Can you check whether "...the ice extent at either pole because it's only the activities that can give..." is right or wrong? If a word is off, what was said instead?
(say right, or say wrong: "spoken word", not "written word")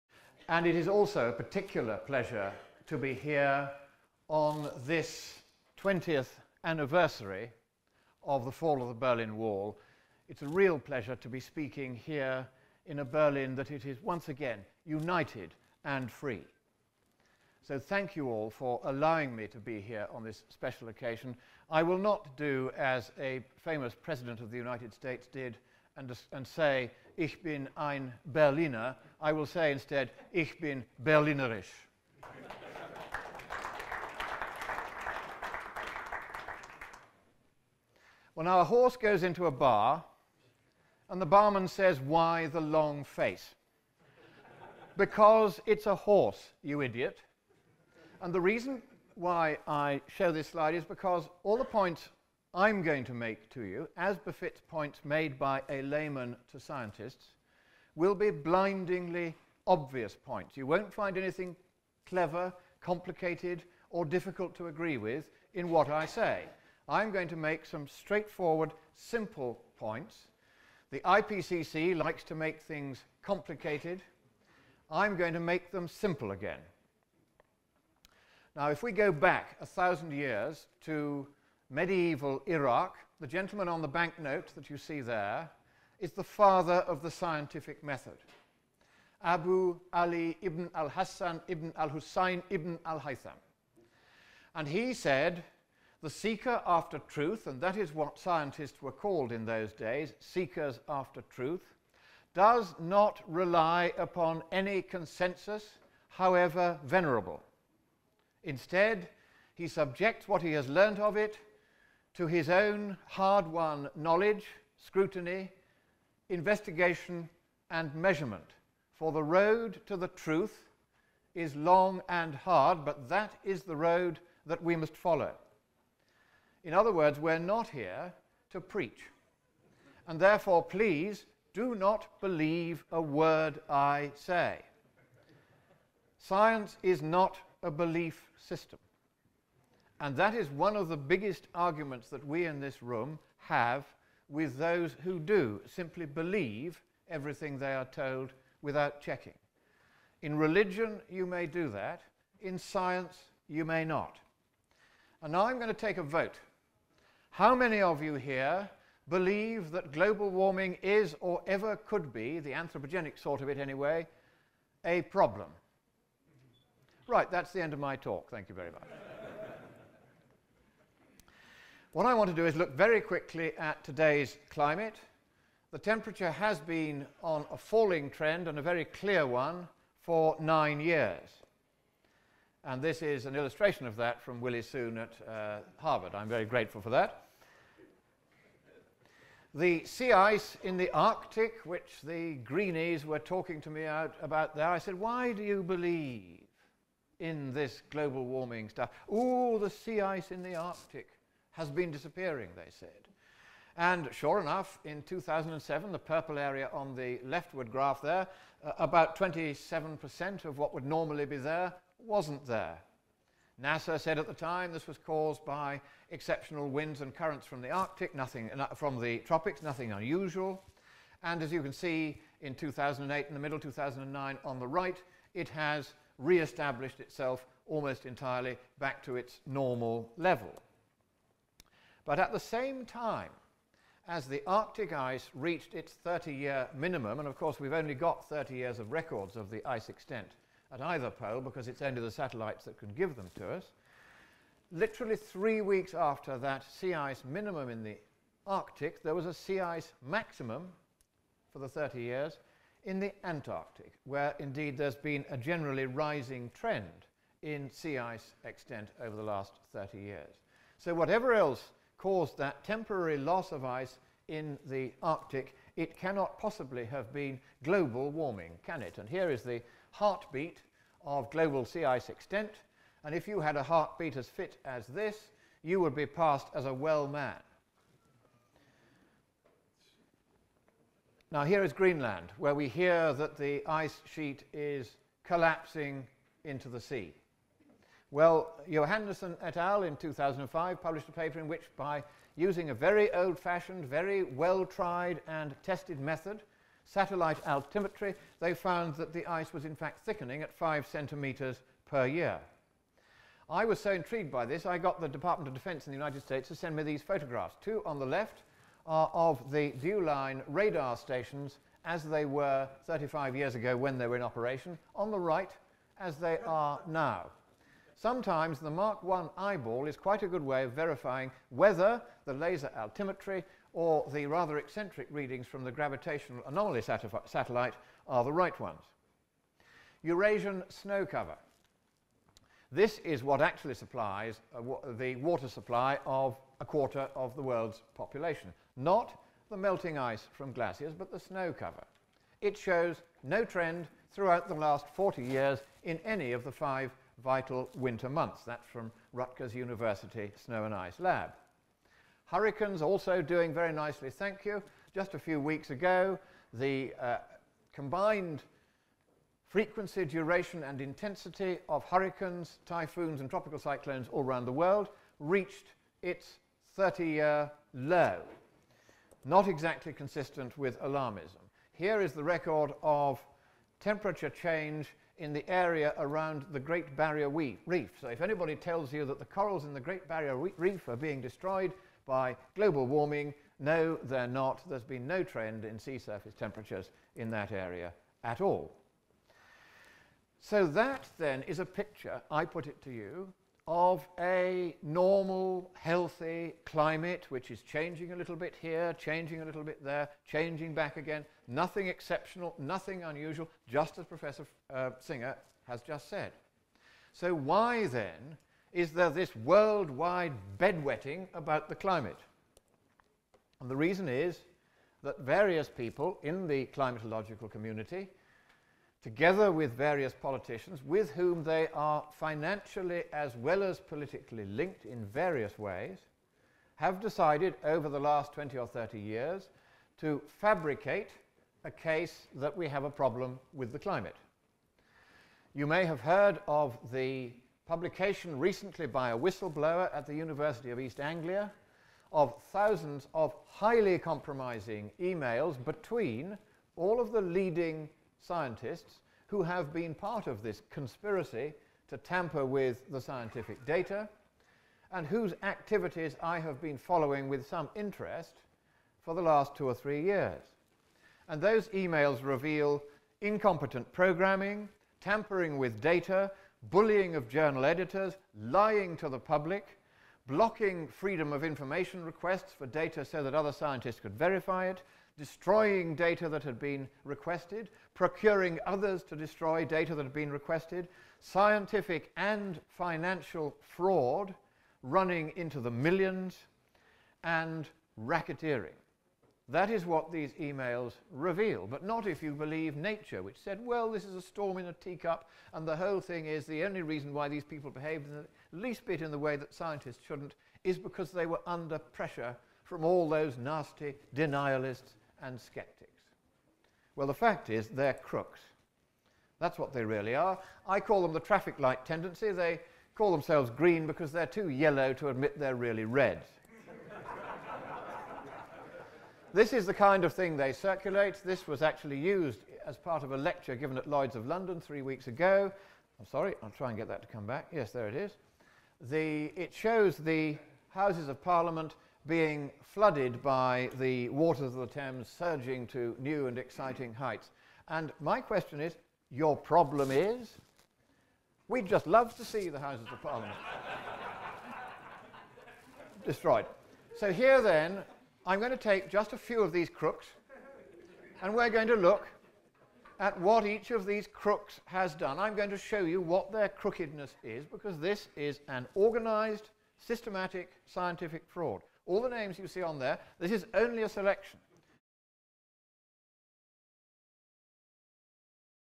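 wrong: "satellites", not "activities".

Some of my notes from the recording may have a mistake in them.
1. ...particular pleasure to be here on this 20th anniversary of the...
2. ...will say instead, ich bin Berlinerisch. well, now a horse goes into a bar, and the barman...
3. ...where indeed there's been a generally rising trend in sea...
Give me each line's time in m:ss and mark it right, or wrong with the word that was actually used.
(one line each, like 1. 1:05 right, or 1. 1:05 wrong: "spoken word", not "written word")
1. 0:01 right
2. 0:29 right
3. 4:14 right.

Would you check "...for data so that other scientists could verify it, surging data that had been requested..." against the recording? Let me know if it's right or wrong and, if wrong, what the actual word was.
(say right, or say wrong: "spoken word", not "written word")
wrong: "destroying", not "surging".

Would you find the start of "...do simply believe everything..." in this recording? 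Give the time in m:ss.
2:25.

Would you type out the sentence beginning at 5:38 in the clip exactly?
Not the melting ice from glaciers, but the snow cover.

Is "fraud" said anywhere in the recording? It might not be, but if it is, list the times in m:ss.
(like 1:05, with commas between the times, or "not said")
8:03, 9:21.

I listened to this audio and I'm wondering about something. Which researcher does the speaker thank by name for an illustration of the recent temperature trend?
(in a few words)
Willie Soon.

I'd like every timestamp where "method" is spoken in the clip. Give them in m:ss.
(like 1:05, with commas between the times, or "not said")
1:27, 4:55.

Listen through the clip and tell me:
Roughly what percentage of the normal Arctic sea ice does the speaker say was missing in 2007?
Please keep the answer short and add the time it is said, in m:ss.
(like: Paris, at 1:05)
27%, at 3:29.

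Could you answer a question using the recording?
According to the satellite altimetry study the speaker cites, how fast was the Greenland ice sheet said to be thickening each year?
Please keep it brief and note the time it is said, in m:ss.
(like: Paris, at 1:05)
5 centimeters, at 5:00.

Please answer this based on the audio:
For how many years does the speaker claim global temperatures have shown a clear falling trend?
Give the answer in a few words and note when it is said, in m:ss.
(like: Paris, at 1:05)
9, at 3:00.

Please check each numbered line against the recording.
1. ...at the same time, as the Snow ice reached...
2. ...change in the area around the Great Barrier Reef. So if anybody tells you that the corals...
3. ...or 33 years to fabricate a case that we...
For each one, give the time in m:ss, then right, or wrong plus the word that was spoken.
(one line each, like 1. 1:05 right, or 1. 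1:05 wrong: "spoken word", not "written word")
1. 3:52 wrong: "Arctic", not "Snow"
2. 6:14 right
3. 7:08 wrong: "30", not "33".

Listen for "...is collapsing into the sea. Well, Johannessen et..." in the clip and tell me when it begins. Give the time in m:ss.
4:44.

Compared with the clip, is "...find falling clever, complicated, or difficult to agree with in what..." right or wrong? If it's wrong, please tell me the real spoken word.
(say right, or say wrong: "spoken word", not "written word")
wrong: "anything", not "falling".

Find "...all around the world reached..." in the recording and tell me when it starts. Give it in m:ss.
6:04.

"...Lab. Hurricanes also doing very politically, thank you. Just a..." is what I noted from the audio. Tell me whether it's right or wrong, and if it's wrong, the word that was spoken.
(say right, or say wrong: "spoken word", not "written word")
wrong: "nicely", not "politically".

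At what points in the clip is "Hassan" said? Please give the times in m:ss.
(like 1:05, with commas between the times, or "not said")
1:30.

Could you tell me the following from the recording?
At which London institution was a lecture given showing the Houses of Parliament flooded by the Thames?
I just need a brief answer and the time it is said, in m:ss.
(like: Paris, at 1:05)
Lloyd's of London, at 8:43.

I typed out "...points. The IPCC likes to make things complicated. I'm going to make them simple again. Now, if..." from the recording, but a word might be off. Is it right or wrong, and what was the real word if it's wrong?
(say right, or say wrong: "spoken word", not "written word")
right.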